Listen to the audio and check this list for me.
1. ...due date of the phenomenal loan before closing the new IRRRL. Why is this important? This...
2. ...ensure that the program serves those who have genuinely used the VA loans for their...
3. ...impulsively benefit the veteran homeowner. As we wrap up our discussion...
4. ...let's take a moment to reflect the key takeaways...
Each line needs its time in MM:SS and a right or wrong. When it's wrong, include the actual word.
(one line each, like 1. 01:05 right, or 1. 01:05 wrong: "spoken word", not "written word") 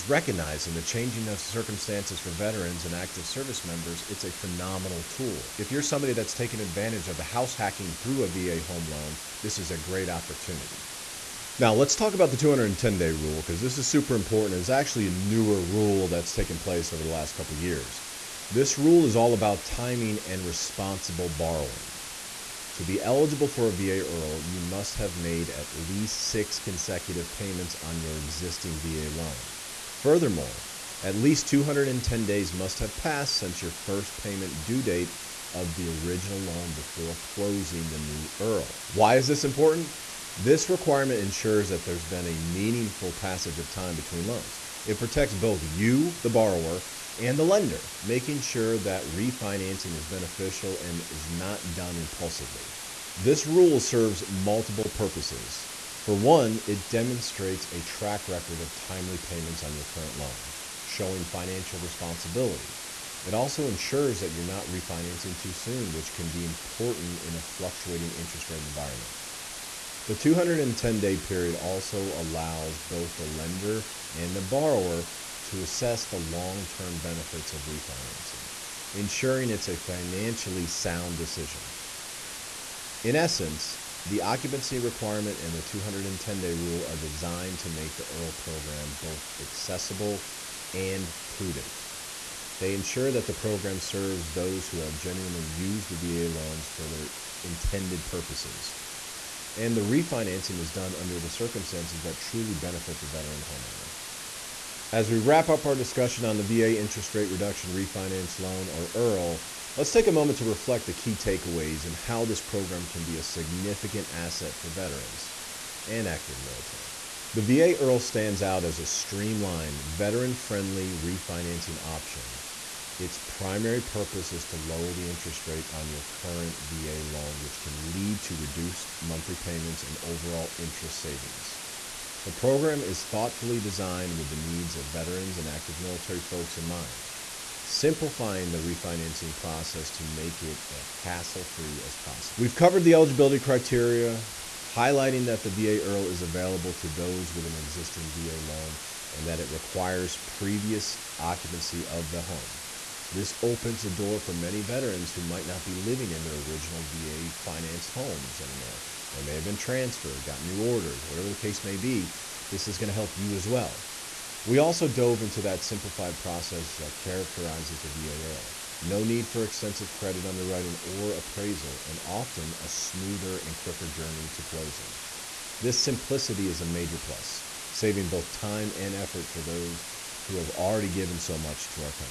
1. 00:34 wrong: "original", not "phenomenal"
2. 01:32 right
3. 01:42 wrong: "truly", not "impulsively"
4. 01:49 right.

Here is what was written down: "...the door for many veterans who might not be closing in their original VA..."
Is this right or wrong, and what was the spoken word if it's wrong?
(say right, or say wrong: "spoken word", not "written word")
wrong: "living", not "closing".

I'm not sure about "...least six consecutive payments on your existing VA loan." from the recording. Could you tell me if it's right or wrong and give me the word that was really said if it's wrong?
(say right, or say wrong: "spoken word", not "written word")
right.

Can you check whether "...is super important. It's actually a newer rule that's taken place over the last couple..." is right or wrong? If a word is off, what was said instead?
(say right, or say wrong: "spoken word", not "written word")
right.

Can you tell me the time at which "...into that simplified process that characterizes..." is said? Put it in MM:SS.
02:45.